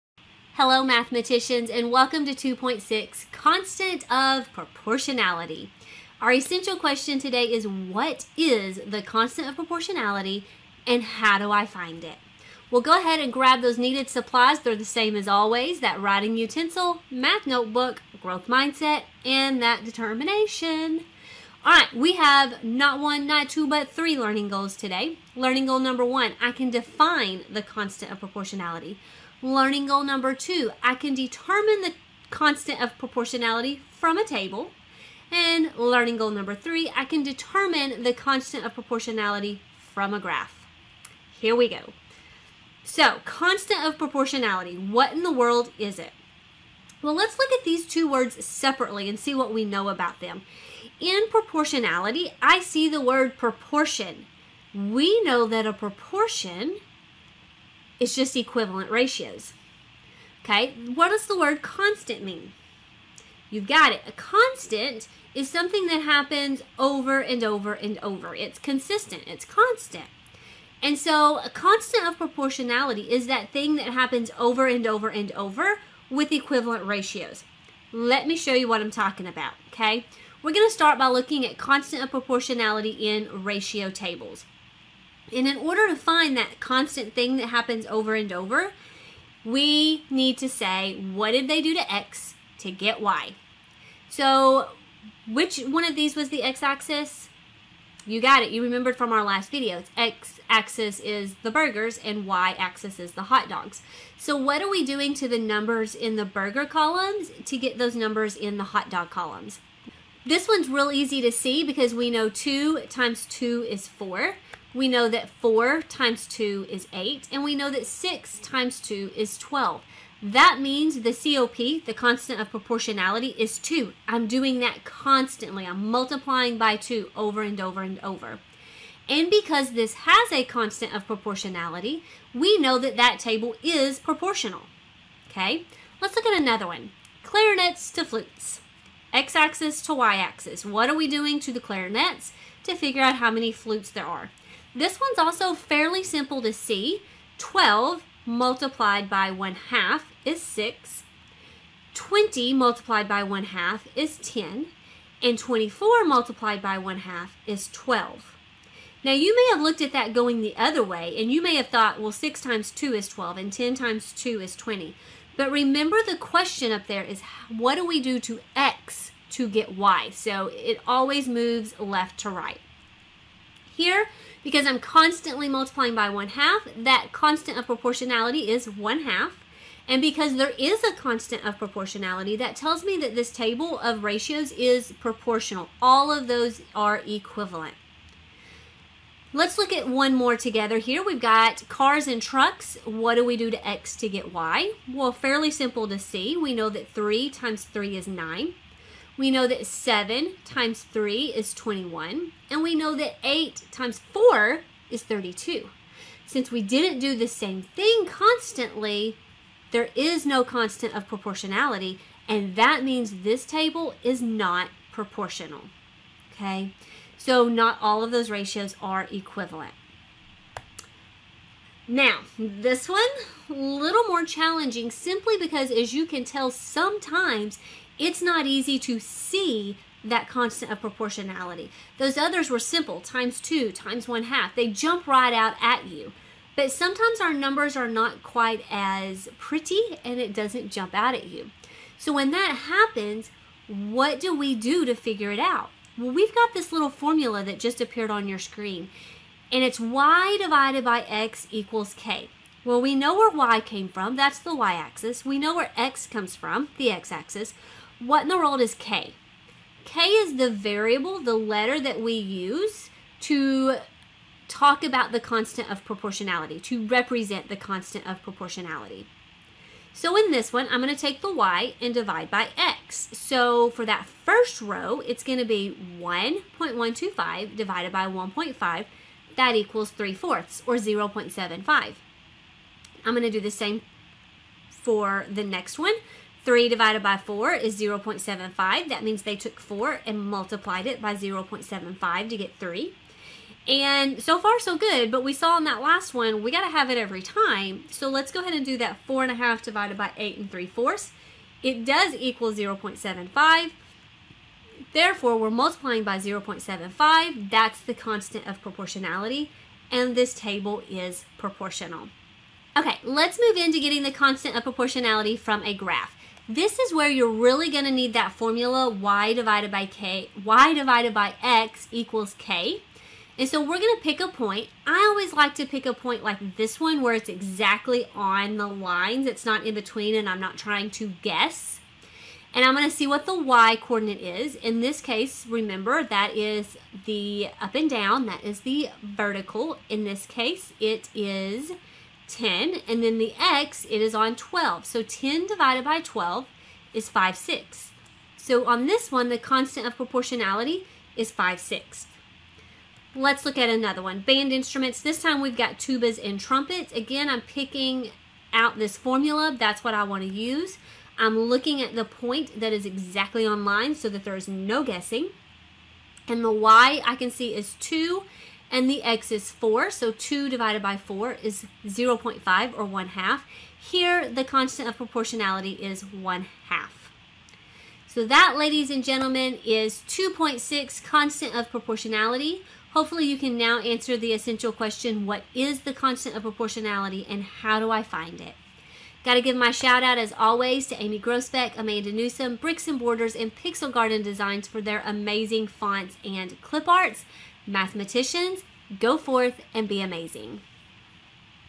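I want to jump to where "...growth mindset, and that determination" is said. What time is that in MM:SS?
00:18.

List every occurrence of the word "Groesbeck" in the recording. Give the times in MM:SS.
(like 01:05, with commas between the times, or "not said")
06:31.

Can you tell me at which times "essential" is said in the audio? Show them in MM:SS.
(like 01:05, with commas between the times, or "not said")
00:06, 06:24.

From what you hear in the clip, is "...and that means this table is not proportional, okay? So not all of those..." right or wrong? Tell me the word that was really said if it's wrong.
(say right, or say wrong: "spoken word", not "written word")
right.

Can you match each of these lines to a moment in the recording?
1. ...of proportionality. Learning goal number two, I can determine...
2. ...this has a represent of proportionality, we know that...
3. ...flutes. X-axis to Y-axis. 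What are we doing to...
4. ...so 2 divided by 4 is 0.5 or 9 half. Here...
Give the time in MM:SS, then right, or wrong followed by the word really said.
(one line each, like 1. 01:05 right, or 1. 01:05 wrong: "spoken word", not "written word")
1. 00:28 right
2. 02:09 wrong: "constant", not "represent"
3. 02:18 right
4. 06:09 wrong: "1", not "9".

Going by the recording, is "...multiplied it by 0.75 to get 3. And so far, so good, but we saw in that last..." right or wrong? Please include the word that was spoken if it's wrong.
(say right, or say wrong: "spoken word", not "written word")
right.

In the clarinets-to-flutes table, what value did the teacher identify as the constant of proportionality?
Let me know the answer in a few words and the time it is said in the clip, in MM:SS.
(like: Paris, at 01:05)
1 half, at 02:56.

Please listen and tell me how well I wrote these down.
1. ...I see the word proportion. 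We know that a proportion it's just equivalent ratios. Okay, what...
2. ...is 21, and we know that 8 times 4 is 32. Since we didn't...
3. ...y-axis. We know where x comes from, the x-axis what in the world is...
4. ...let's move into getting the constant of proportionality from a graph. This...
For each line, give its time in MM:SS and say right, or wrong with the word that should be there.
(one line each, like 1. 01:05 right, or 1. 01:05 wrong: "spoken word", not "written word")
1. 00:52 right
2. 03:21 right
3. 04:14 right
4. 05:13 right.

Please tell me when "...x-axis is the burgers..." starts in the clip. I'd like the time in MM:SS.
01:39.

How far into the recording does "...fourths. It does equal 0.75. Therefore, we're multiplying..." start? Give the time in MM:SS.
05:00.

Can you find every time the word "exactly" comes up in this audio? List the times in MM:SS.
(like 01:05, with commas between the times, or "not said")
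05:27, 06:02.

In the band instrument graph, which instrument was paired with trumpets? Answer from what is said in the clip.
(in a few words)
tubas.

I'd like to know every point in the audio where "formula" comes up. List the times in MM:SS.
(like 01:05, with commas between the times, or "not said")
04:06, 05:18, 05:58.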